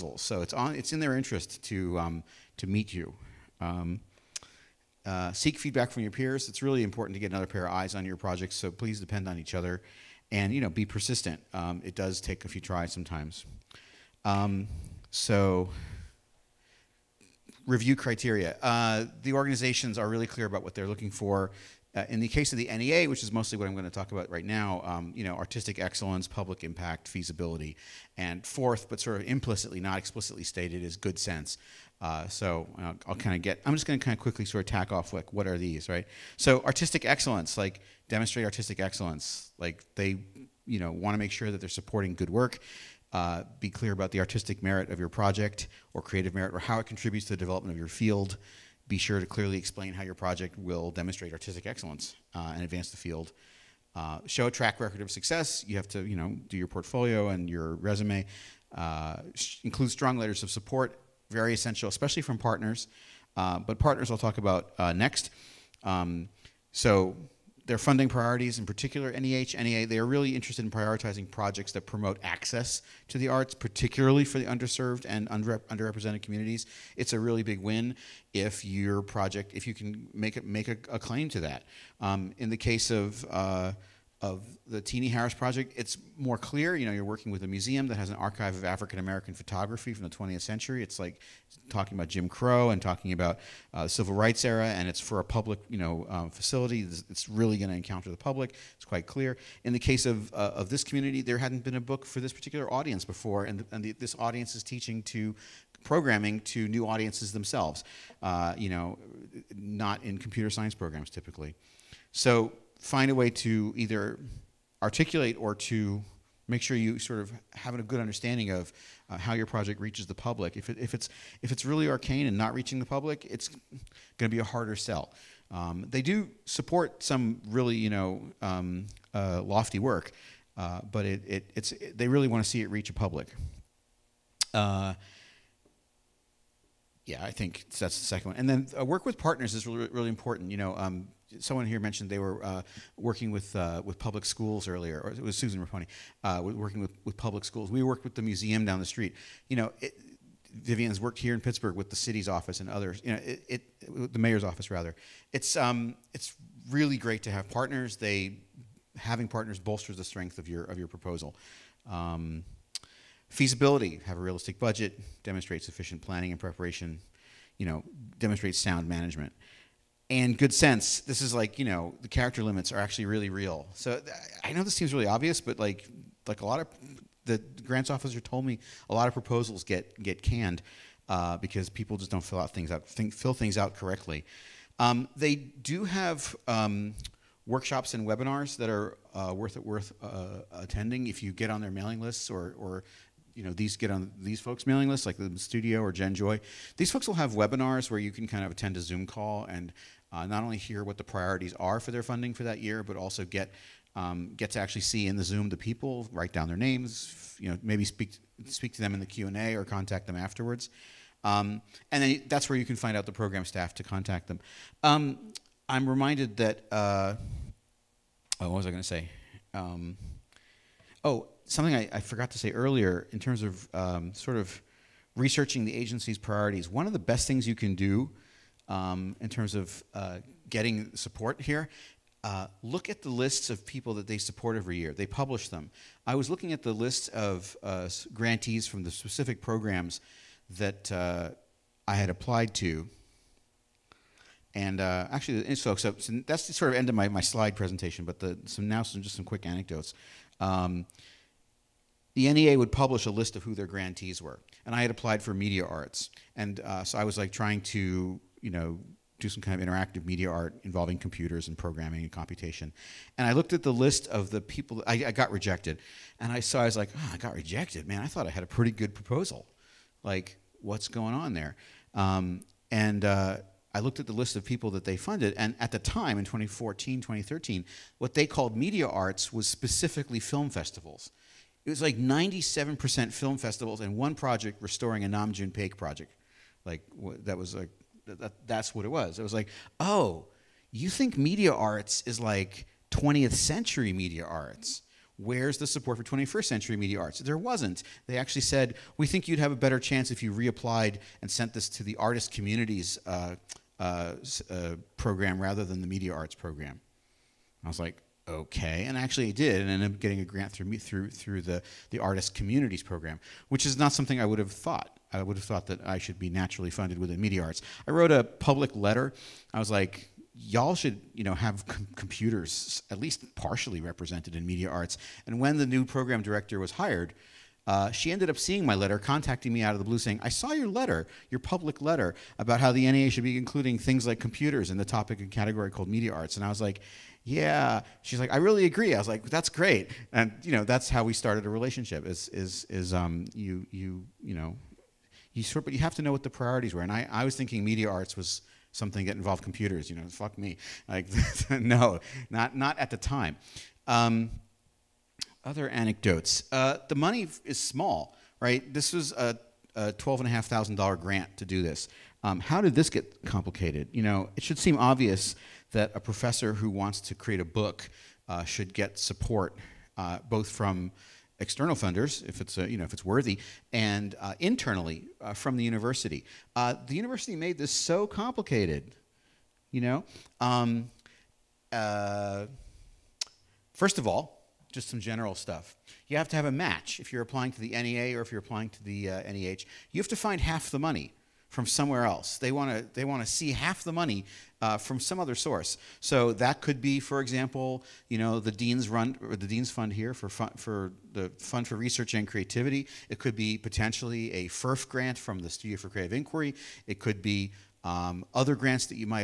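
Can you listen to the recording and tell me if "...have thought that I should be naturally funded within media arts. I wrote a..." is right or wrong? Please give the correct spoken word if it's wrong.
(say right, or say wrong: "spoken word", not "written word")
right.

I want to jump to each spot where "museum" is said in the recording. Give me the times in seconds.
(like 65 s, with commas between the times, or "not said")
87 s, 148 s.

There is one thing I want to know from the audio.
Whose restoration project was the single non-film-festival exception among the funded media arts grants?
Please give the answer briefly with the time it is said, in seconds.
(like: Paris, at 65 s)
Nam June Paik, at 285 s.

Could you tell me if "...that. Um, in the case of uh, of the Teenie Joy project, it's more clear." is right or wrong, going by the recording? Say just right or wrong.
wrong.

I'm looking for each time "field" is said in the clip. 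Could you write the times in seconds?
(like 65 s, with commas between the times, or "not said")
47 s, 52 s.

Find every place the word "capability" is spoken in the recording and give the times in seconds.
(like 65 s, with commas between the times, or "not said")
not said.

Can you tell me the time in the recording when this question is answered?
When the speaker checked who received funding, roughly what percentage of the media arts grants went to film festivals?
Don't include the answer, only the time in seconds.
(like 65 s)
281 s.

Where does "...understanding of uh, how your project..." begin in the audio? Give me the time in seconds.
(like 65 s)
117 s.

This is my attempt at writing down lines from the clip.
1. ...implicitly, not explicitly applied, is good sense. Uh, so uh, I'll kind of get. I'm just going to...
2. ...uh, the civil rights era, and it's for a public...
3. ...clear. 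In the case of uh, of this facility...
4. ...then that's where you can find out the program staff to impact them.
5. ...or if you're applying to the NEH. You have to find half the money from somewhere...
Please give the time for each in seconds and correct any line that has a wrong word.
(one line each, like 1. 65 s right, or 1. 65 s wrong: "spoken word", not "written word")
1. 29 s wrong: "stated", not "applied"
2. 93 s right
3. 99 s wrong: "community", not "facility"
4. 212 s wrong: "contact", not "impact"
5. 388 s right.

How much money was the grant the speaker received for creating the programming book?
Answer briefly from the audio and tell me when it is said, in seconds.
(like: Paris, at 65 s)
$12,500, at 359 s.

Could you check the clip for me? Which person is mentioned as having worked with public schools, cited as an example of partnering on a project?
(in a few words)
Susan Raponi.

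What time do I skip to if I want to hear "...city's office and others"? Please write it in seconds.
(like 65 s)
151 s.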